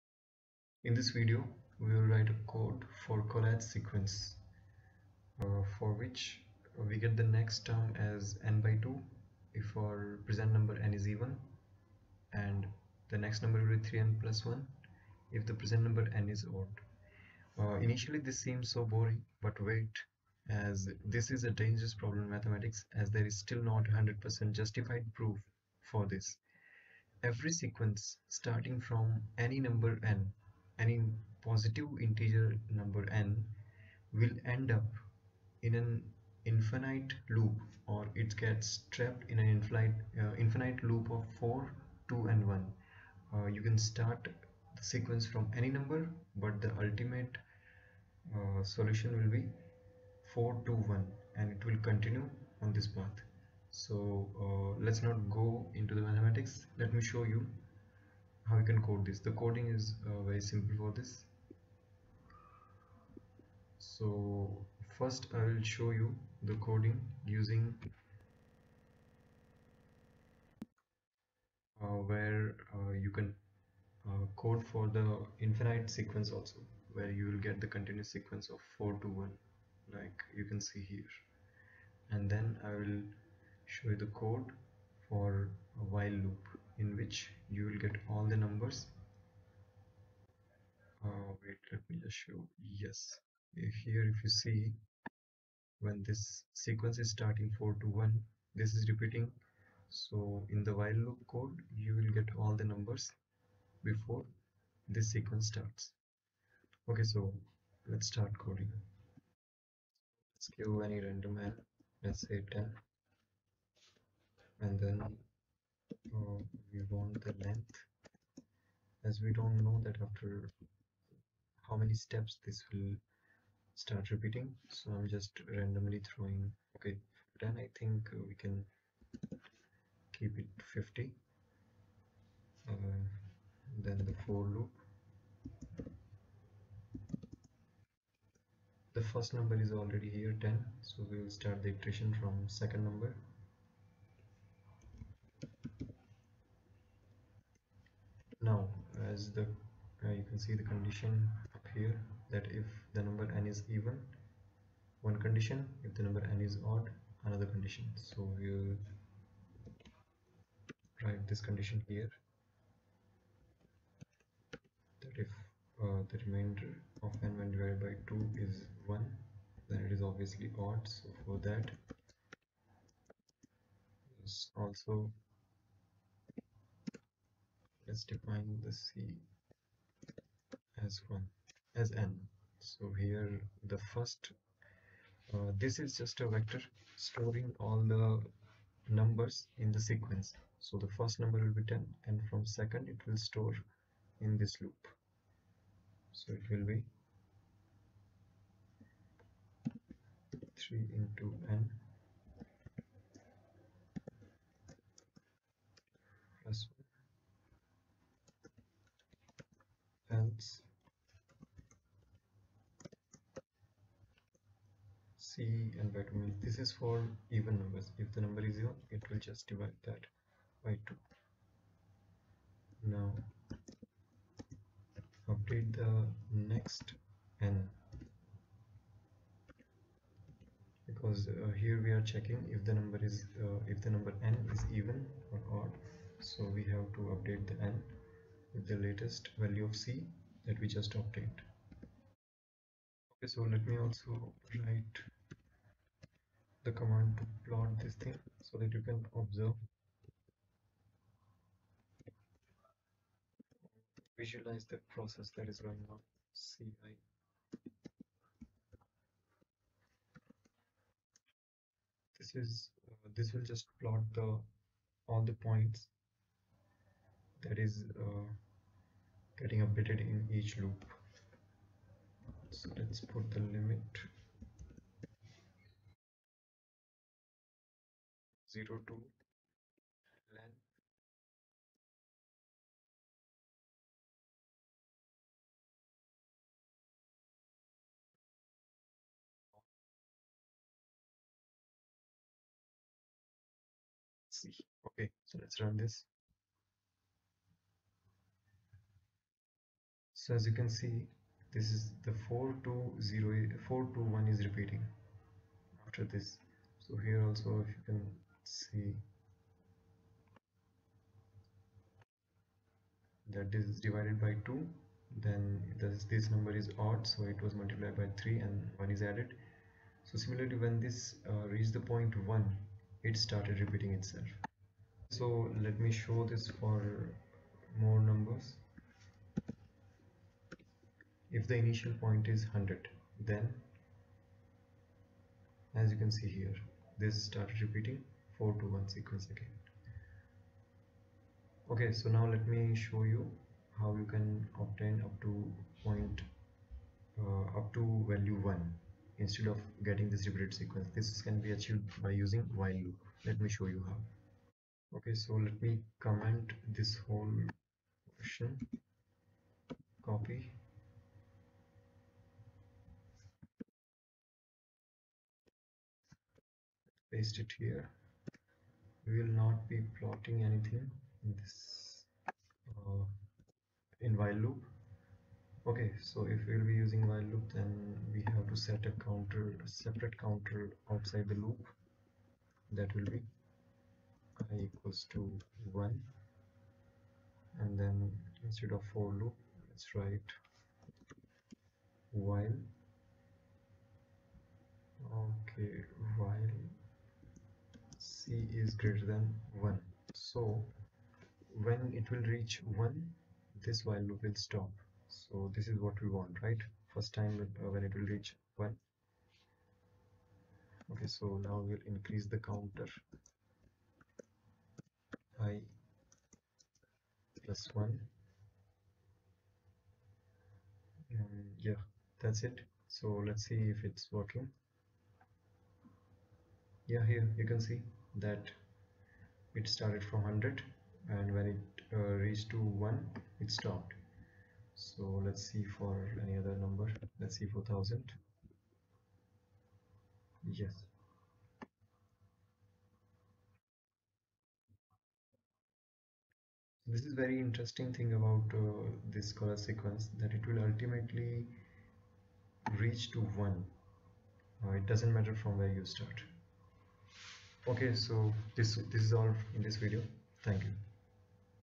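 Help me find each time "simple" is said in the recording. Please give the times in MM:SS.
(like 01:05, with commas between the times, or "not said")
01:00.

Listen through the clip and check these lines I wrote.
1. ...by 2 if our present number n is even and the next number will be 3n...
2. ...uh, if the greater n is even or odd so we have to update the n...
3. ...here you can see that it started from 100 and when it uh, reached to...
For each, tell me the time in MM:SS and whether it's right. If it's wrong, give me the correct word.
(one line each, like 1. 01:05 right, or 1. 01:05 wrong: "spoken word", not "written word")
1. 00:08 right
2. 03:53 wrong: "number", not "greater"
3. 07:07 right.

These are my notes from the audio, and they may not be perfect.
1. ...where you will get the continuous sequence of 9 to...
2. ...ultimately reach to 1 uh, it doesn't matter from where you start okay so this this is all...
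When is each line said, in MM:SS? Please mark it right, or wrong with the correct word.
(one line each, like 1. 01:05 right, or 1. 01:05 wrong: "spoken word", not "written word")
1. 01:16 wrong: "4", not "9"
2. 07:30 right.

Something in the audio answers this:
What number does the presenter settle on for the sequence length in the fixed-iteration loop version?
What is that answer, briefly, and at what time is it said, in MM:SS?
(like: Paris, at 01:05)
50, at 02:10.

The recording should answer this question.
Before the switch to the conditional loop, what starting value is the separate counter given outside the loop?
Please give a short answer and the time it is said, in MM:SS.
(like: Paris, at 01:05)
1, at 06:24.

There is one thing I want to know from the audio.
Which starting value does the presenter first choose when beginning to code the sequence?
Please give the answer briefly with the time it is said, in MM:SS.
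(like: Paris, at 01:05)
10, at 01:51.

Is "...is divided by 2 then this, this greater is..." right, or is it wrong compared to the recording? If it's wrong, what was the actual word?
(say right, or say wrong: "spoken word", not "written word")
wrong: "number", not "greater".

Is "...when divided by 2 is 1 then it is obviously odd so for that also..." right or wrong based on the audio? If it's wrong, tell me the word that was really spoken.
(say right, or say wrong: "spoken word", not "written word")
right.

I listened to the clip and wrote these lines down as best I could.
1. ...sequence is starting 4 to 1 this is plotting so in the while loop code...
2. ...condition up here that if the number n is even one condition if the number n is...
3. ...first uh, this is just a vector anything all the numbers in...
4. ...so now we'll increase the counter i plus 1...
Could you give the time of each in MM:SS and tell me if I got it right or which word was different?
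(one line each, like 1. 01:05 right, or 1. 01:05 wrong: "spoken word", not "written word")
1. 01:36 wrong: "repeating", not "plotting"
2. 02:30 right
3. 03:03 wrong: "storing", not "anything"
4. 06:51 right.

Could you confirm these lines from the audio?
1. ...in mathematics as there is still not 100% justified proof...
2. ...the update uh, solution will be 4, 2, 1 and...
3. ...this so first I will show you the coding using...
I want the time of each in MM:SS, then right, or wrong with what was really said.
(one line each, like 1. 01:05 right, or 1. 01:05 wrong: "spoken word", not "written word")
1. 00:22 right
2. 00:46 wrong: "ultimate", not "update"
3. 01:00 right.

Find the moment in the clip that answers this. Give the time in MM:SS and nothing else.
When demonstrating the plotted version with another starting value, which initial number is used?
05:31.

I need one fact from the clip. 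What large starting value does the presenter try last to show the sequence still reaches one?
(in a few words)
4000.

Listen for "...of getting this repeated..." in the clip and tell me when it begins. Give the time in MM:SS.
05:49.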